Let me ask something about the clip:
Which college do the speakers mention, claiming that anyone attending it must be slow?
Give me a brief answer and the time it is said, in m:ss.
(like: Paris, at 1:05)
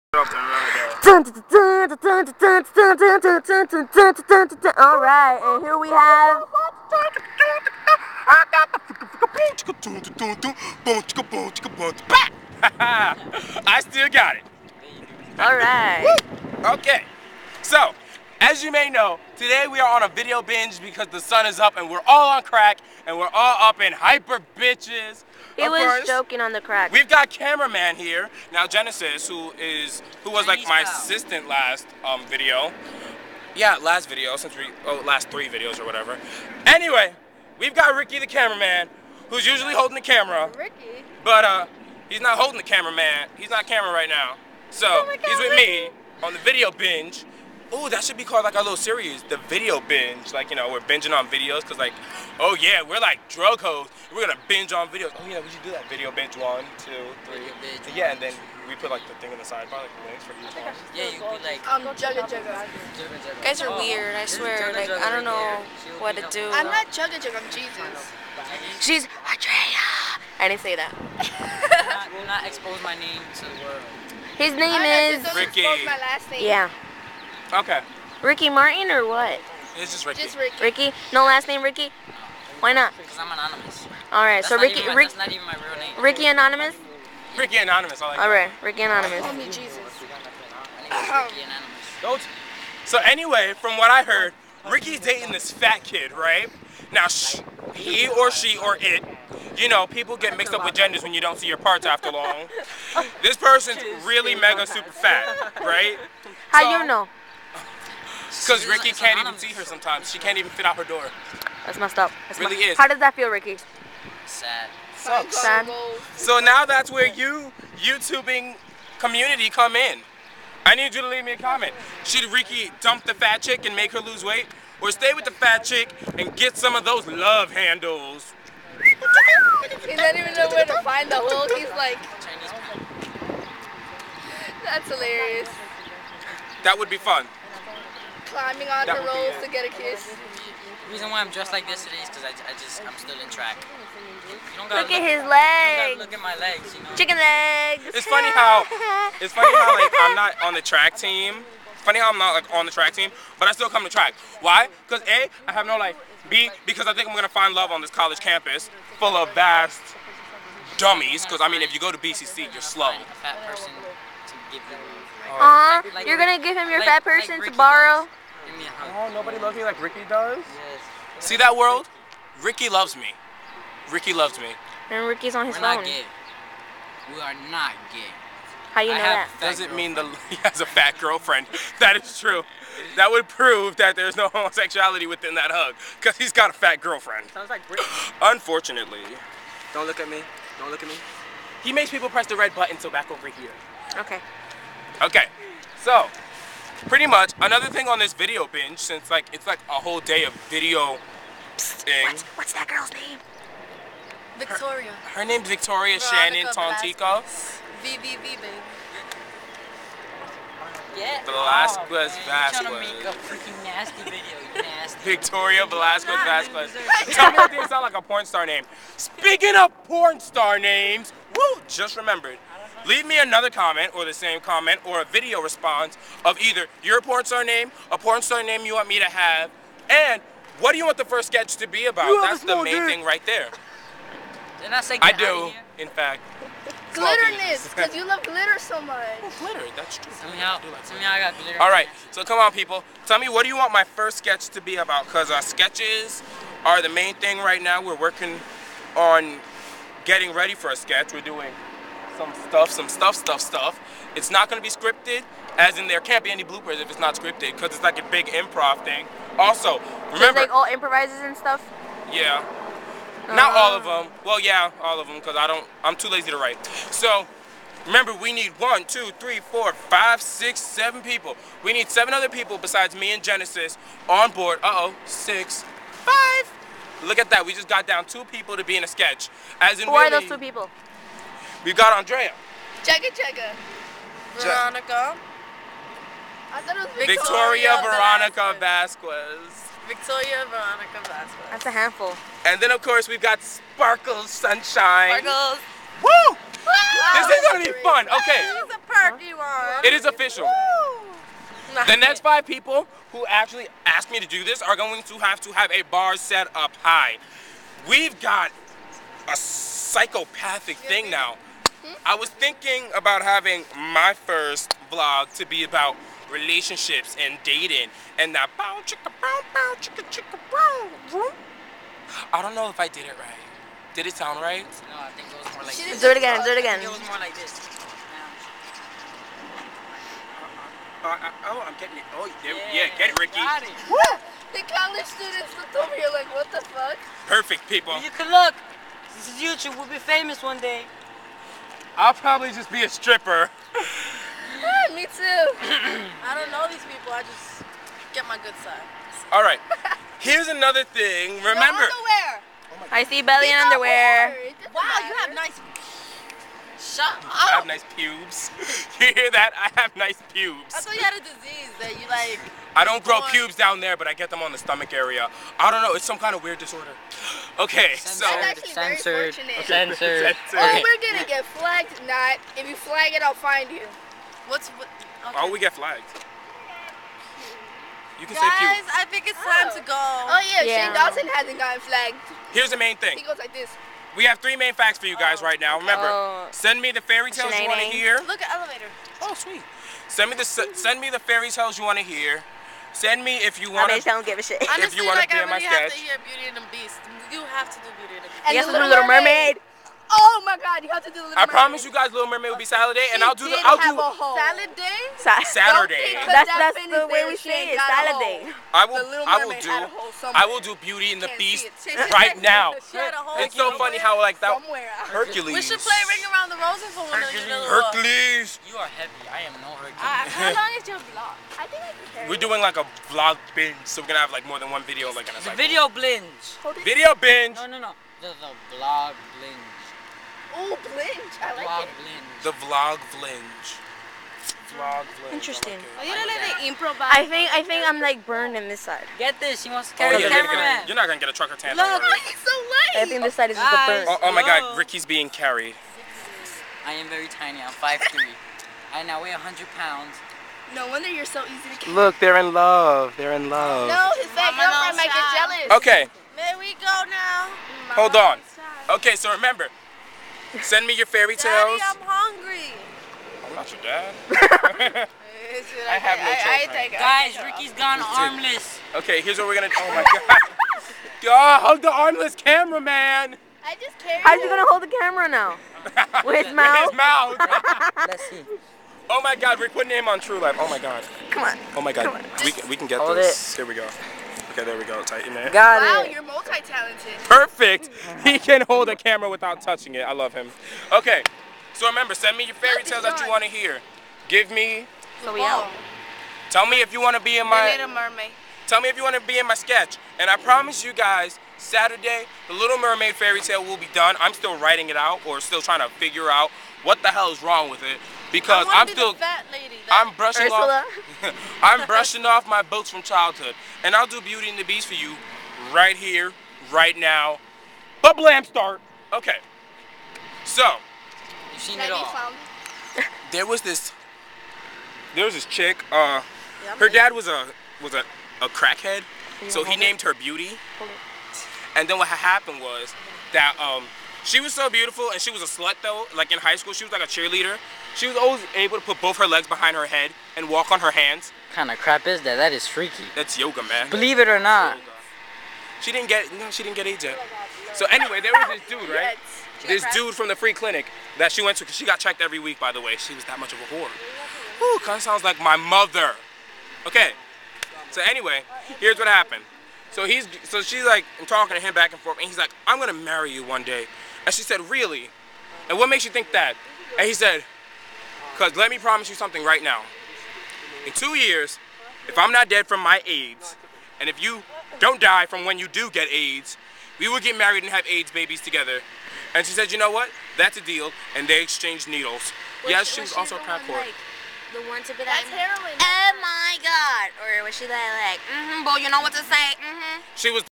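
BCC, at 2:41.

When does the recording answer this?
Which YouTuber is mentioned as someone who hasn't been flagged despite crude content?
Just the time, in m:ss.
6:20.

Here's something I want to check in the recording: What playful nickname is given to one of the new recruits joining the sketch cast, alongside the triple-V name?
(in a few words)
Sparkles Sunshine.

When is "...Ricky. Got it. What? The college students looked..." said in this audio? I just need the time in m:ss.
5:33.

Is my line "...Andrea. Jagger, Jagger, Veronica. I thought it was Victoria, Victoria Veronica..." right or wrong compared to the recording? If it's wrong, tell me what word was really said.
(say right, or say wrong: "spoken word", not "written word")
right.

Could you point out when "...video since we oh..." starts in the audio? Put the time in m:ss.
0:34.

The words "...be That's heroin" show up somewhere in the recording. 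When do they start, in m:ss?
9:44.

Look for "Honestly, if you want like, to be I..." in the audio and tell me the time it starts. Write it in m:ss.
6:34.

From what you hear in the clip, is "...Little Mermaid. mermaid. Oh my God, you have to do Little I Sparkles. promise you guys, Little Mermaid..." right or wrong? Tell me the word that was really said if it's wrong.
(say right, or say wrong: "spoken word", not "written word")
wrong: "Mermaid", not "Sparkles".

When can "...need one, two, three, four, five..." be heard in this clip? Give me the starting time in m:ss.
4:28.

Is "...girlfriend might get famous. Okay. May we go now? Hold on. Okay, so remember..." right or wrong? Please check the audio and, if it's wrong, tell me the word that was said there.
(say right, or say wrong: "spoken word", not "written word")
wrong: "jealous", not "famous".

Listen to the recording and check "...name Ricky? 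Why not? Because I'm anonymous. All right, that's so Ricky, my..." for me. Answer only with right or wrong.
right.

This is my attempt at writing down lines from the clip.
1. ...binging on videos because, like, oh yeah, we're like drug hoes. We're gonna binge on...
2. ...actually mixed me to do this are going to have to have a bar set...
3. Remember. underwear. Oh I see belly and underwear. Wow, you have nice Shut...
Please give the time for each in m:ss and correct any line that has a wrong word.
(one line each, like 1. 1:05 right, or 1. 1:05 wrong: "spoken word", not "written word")
1. 0:50 right
2. 5:03 wrong: "asked", not "mixed"
3. 5:51 right.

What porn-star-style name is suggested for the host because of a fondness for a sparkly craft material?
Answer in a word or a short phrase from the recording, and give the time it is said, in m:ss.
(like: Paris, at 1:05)
Glitterness, at 3:56.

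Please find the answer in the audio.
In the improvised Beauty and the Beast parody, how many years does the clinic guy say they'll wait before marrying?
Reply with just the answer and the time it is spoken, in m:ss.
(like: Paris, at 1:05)
2, at 9:30.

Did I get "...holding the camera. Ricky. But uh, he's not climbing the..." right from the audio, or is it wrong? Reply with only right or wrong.
wrong.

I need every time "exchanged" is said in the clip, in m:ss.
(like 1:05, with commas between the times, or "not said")
9:41.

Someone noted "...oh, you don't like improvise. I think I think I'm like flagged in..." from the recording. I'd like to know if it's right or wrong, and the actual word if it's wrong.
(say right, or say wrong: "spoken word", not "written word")
wrong: "burned", not "flagged".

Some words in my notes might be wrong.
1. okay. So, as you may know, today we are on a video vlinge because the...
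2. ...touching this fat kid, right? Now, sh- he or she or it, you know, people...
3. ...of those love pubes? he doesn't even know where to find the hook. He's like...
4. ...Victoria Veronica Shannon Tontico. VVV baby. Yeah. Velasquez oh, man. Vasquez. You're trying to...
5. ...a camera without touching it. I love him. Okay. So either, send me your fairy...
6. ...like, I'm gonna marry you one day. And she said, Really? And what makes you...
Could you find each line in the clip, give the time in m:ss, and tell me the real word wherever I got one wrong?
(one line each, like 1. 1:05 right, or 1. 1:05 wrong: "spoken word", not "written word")
1. 0:16 wrong: "binge", not "vlinge"
2. 1:34 wrong: "dating", not "touching"
3. 2:06 wrong: "handles", not "pubes"
4. 3:25 right
5. 8:08 wrong: "remember", not "either"
6. 9:22 right.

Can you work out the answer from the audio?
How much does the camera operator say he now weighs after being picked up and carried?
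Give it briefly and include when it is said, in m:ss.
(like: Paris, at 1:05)
100 pounds, at 7:29.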